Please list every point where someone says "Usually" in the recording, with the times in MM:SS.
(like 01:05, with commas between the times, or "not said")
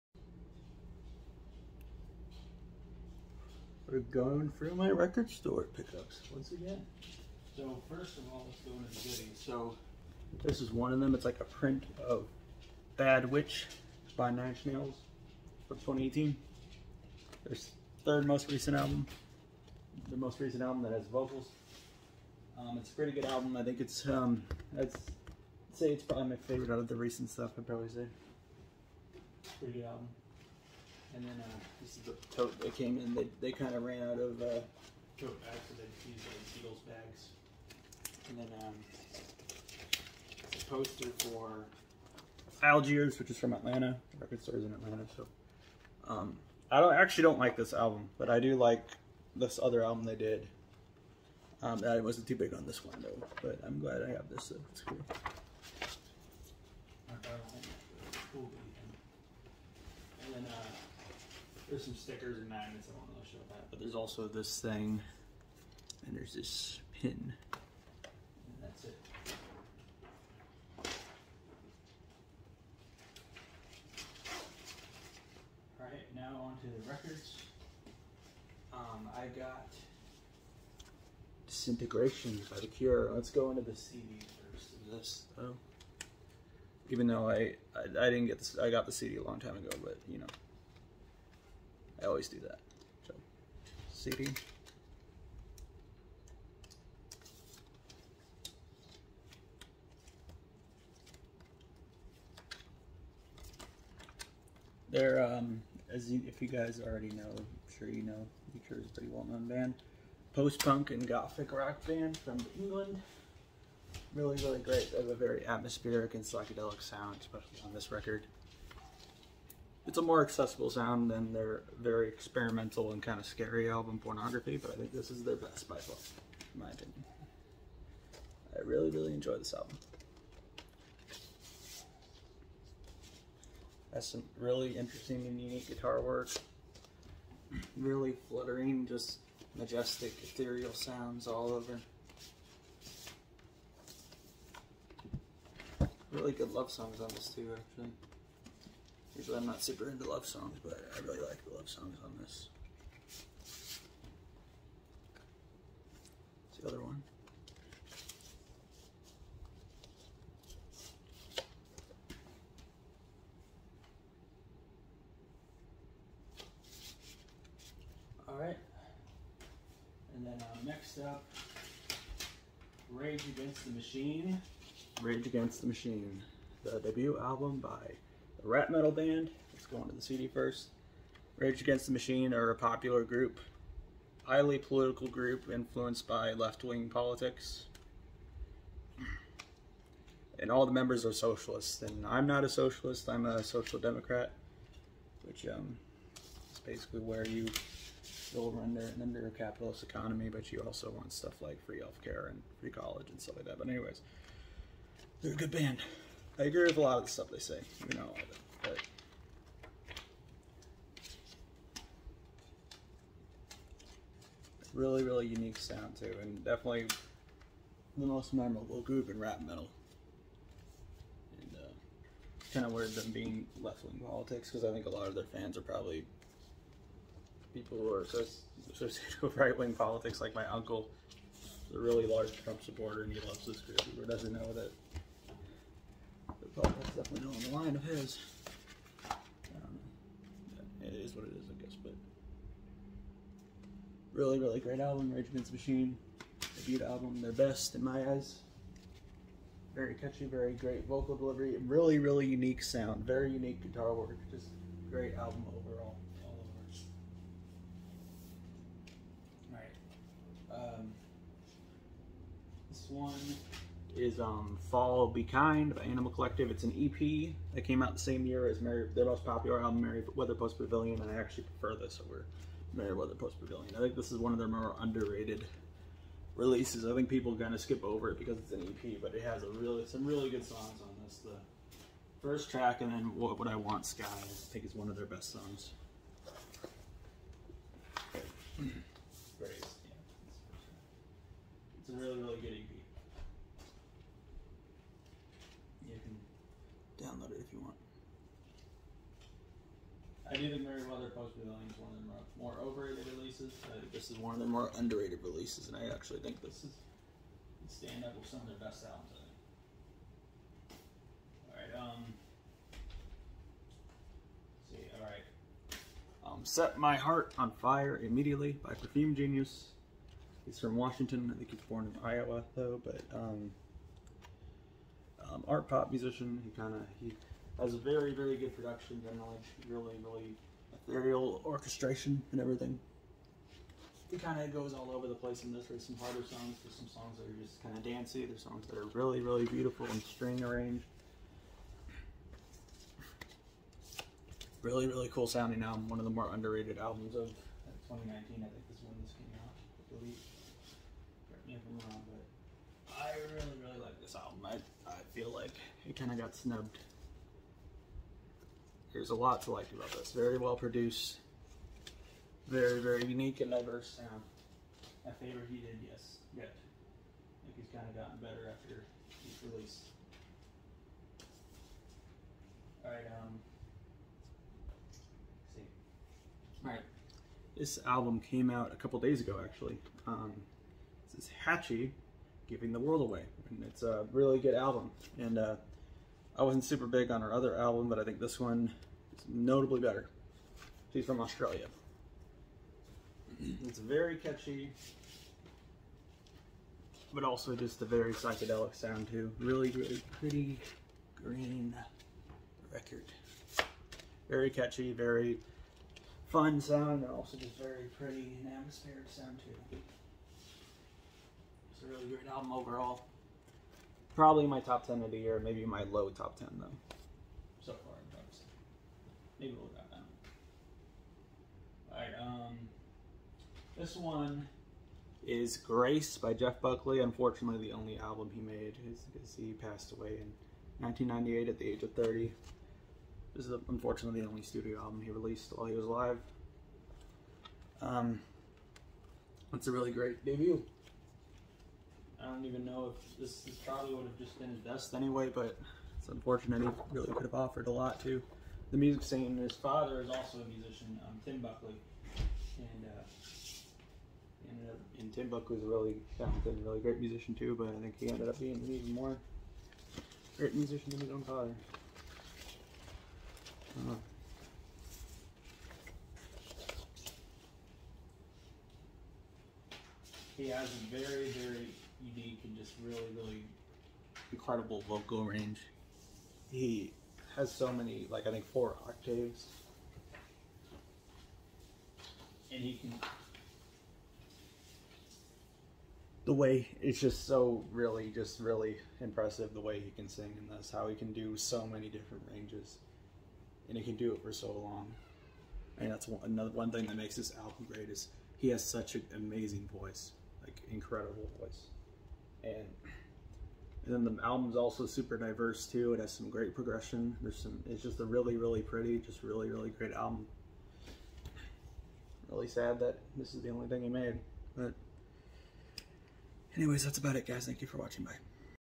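02:29.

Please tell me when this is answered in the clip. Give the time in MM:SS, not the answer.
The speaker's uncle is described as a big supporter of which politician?
03:52.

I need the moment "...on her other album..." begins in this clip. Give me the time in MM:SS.
06:27.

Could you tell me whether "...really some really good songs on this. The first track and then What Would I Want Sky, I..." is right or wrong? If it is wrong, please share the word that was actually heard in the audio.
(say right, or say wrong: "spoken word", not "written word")
right.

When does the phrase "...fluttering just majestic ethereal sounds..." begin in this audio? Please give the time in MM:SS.
02:18.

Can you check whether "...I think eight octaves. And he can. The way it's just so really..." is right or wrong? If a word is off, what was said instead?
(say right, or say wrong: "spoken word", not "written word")
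wrong: "four", not "eight".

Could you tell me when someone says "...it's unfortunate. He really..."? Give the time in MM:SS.
07:25.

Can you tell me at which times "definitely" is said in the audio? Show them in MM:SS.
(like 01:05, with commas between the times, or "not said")
03:36, 03:57.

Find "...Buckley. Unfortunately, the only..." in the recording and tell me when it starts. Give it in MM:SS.
07:06.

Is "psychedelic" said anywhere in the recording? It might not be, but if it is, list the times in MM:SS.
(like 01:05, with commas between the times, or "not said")
01:56, 06:38.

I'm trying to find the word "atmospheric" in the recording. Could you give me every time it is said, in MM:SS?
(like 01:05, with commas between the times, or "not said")
01:55, 06:48.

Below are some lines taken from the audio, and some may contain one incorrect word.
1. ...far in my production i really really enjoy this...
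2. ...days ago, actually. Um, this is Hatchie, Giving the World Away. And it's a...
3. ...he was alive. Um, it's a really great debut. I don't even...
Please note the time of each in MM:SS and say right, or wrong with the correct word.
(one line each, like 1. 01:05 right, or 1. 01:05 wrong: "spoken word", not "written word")
1. 02:05 wrong: "opinion", not "production"
2. 06:18 right
3. 07:15 right.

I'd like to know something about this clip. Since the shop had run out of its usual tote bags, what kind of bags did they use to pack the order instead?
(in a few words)
Seagulls bags.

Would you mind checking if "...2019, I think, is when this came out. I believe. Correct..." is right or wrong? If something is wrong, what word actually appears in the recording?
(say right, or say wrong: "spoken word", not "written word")
right.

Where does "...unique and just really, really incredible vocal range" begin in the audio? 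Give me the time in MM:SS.
07:52.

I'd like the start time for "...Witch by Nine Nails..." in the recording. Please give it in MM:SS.
00:13.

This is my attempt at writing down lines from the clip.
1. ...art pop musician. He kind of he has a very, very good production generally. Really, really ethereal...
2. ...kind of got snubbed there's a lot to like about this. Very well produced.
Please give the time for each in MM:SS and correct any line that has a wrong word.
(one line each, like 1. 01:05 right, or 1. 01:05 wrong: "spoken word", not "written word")
1. 05:25 right
2. 05:55 right.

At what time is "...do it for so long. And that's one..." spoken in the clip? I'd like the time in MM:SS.
08:13.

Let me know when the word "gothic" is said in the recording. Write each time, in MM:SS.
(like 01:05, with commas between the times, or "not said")
01:51.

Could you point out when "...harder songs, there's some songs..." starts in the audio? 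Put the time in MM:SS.
05:35.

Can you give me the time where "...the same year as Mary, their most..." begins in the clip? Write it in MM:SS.
04:27.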